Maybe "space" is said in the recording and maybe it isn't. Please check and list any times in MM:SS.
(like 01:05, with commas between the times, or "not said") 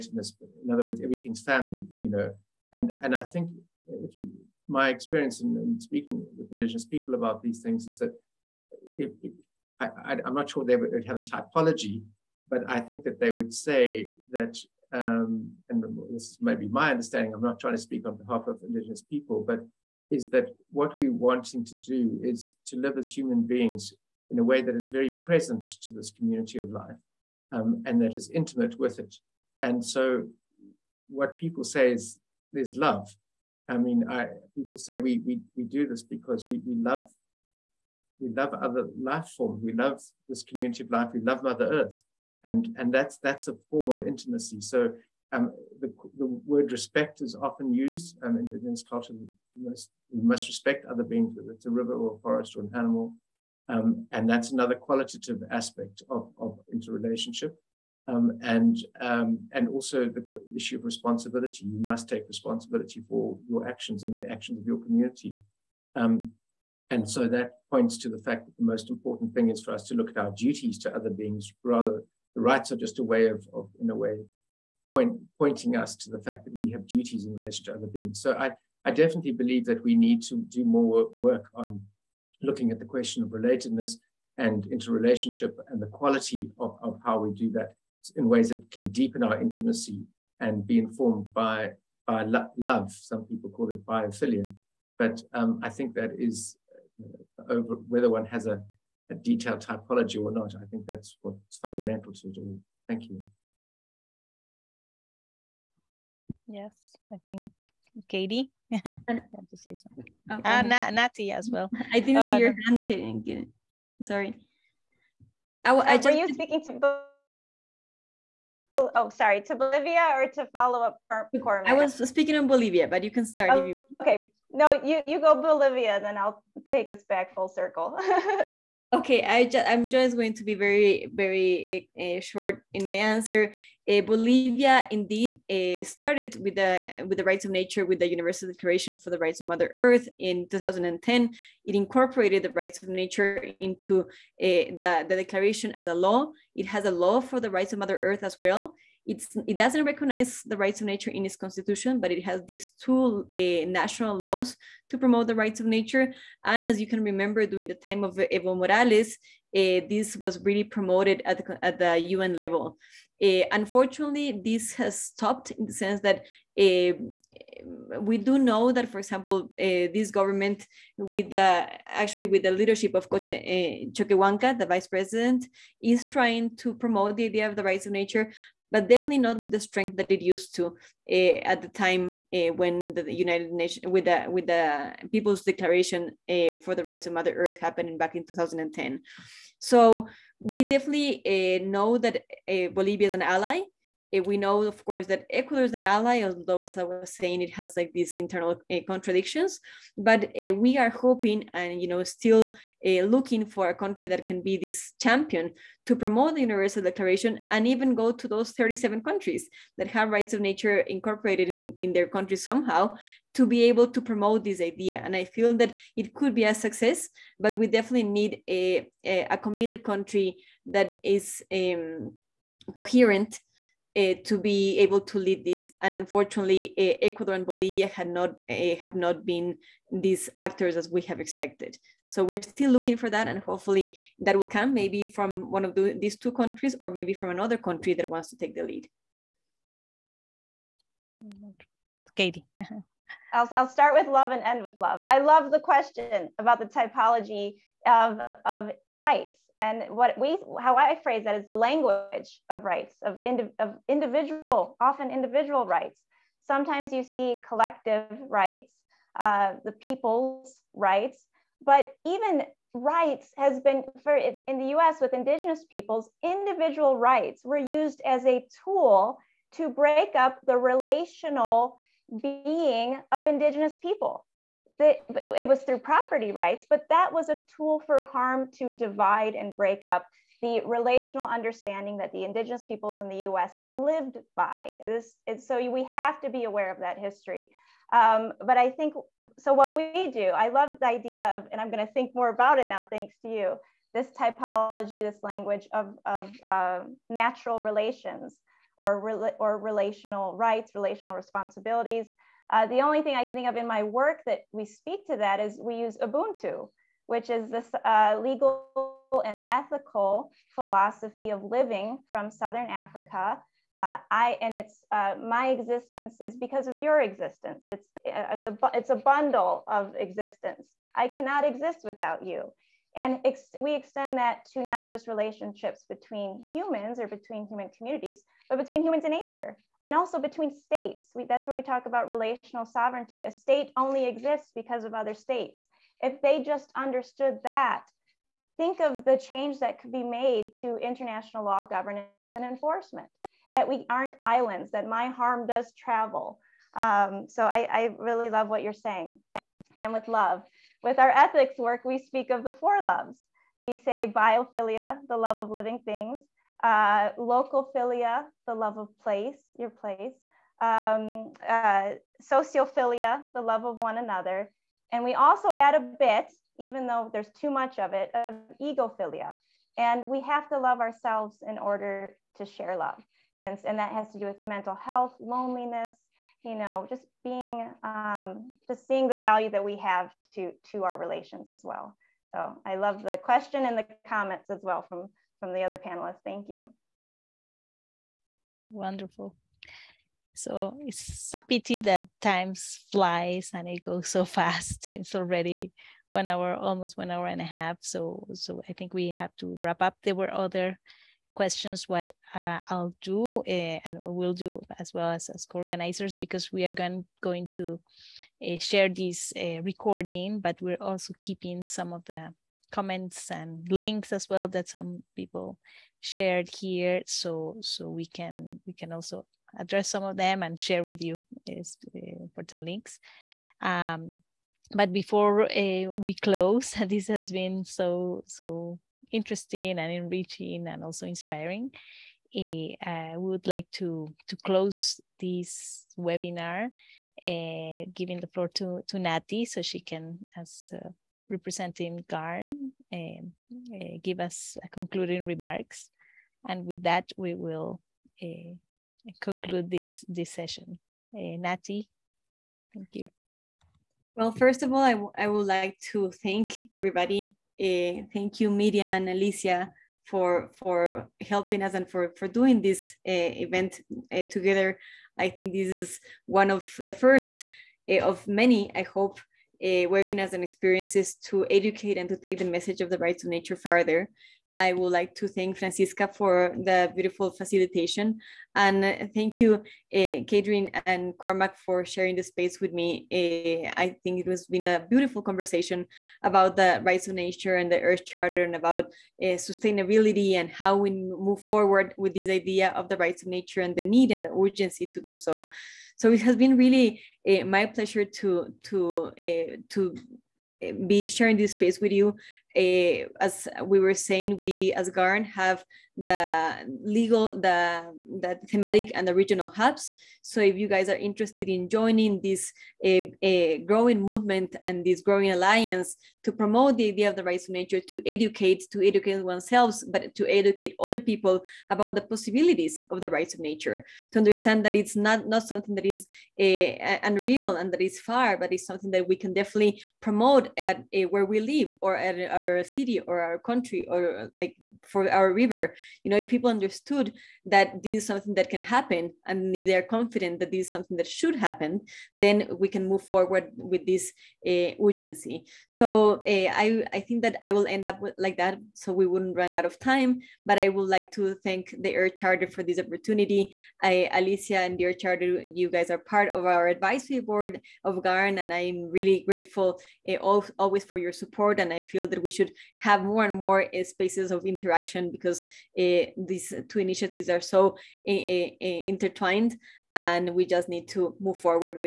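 08:02, 08:21, 09:23.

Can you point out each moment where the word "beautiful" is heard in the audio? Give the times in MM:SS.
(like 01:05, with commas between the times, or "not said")
07:56, 08:04.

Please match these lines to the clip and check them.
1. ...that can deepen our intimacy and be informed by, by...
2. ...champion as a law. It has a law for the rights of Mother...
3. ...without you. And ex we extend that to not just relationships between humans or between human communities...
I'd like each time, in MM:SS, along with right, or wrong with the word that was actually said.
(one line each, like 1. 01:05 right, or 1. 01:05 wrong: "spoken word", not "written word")
1. 01:28 right
2. 02:25 wrong: "declaration", not "champion"
3. 05:21 right.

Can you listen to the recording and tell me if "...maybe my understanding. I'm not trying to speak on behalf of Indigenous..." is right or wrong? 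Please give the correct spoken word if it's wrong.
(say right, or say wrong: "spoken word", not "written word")
right.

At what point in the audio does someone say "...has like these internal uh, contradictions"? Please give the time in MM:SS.
03:17.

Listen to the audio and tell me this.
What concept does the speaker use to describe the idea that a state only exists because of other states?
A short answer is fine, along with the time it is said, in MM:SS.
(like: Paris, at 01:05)
relational sovereignty, at 05:32.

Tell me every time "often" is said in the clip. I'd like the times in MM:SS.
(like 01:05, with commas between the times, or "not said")
00:47, 04:14.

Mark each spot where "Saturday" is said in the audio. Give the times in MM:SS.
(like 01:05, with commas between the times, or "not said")
not said.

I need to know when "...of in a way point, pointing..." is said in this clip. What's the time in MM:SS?
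01:13.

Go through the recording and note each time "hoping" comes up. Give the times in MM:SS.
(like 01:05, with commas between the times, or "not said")
03:20.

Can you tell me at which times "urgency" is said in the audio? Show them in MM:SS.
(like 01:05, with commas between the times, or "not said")
08:14, 09:04.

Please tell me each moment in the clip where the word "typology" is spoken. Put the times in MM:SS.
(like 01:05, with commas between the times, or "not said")
00:11, 01:39, 04:06, 04:54.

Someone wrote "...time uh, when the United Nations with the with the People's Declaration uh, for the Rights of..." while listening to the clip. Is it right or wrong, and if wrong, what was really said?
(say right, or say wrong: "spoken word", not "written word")
right.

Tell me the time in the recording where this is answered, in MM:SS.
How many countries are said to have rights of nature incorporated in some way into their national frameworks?
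03:28.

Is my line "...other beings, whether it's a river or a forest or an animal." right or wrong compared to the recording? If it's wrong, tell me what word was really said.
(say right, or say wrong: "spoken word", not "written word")
right.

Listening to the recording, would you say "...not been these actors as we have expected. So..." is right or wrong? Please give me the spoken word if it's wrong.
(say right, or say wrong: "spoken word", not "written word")
right.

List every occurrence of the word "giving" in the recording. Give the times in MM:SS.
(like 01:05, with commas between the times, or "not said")
07:17.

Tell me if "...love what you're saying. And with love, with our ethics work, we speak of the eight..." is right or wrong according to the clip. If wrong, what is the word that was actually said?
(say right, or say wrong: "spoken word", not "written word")
wrong: "four", not "eight".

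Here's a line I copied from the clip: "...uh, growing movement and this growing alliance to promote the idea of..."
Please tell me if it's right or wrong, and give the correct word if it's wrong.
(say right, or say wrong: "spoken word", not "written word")
right.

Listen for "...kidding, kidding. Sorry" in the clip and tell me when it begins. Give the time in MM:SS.
01:52.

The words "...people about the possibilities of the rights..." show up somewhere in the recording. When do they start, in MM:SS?
08:40.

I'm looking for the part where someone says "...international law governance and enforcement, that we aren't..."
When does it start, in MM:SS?
05:40.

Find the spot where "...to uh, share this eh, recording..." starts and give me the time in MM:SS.
06:47.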